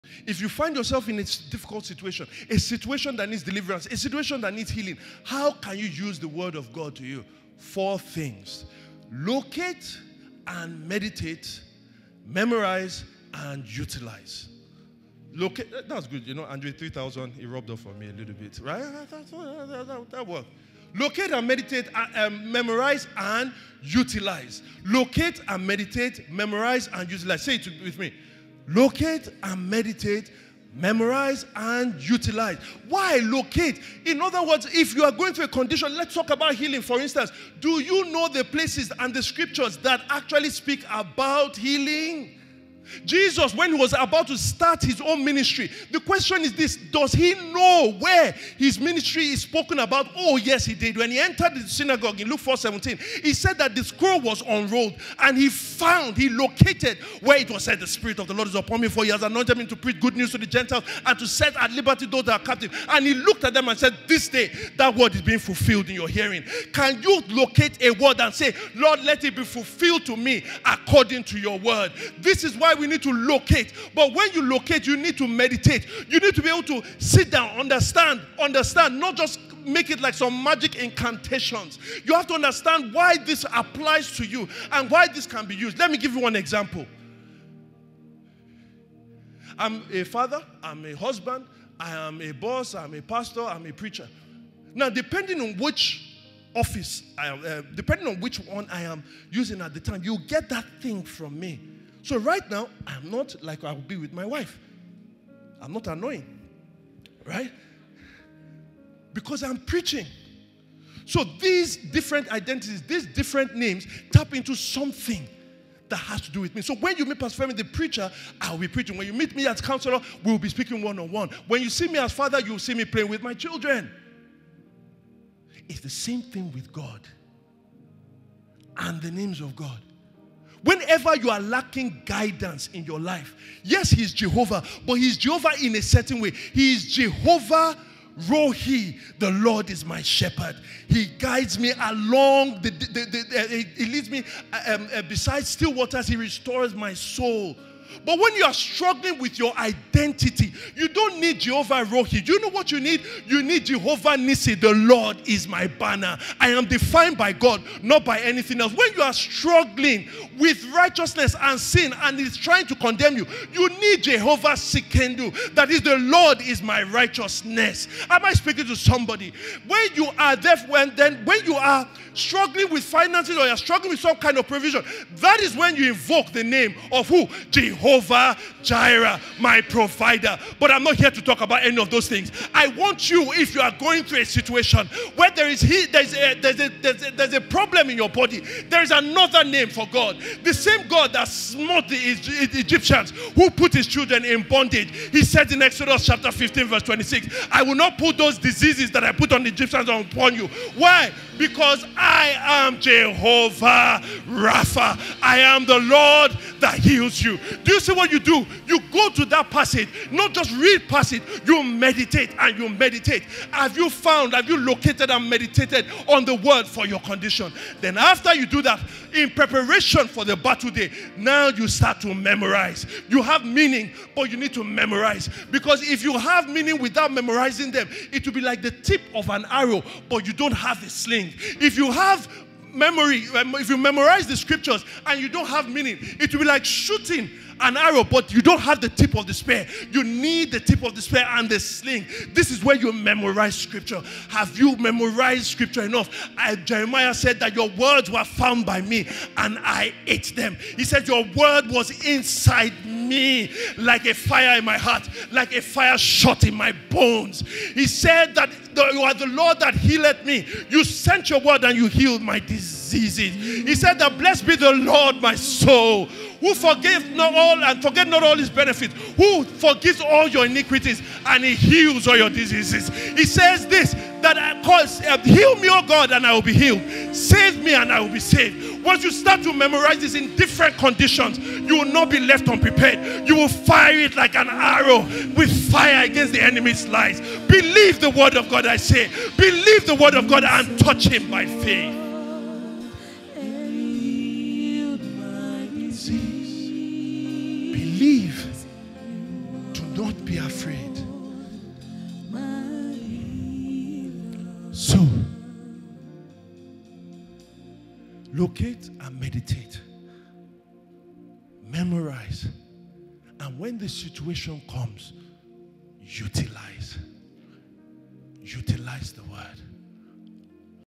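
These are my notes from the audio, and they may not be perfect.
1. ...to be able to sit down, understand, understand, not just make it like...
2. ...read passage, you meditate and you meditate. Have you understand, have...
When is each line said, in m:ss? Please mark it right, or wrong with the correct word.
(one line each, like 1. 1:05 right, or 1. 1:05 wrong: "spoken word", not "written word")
1. 1:16 right
2. 3:30 wrong: "found", not "understand".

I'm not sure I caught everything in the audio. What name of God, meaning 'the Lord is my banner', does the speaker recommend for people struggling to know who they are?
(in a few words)
Jehovah Nisi.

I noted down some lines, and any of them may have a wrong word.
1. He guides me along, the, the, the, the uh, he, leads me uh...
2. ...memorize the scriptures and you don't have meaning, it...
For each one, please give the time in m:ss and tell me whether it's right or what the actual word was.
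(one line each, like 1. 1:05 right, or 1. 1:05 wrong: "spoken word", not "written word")
1. 2:20 right
2. 3:53 right.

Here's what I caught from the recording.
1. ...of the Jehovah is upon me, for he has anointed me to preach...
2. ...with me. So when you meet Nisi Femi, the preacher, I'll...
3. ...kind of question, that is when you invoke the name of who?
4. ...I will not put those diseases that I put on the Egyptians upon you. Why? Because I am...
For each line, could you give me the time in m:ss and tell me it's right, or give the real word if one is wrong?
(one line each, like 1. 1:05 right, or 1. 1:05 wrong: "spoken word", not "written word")
1. 0:58 wrong: "Lord", not "Jehovah"
2. 1:56 wrong: "Pastor", not "Nisi"
3. 2:54 wrong: "provision", not "question"
4. 3:17 right.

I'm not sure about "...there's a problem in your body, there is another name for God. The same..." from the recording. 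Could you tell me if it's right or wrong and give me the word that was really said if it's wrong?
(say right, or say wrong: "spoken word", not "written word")
right.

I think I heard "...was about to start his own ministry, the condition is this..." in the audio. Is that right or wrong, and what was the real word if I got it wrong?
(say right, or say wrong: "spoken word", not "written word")
wrong: "question", not "condition".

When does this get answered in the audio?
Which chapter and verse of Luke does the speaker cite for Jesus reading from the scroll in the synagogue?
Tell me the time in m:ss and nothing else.
0:52.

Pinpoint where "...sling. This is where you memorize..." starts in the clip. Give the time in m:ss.
4:01.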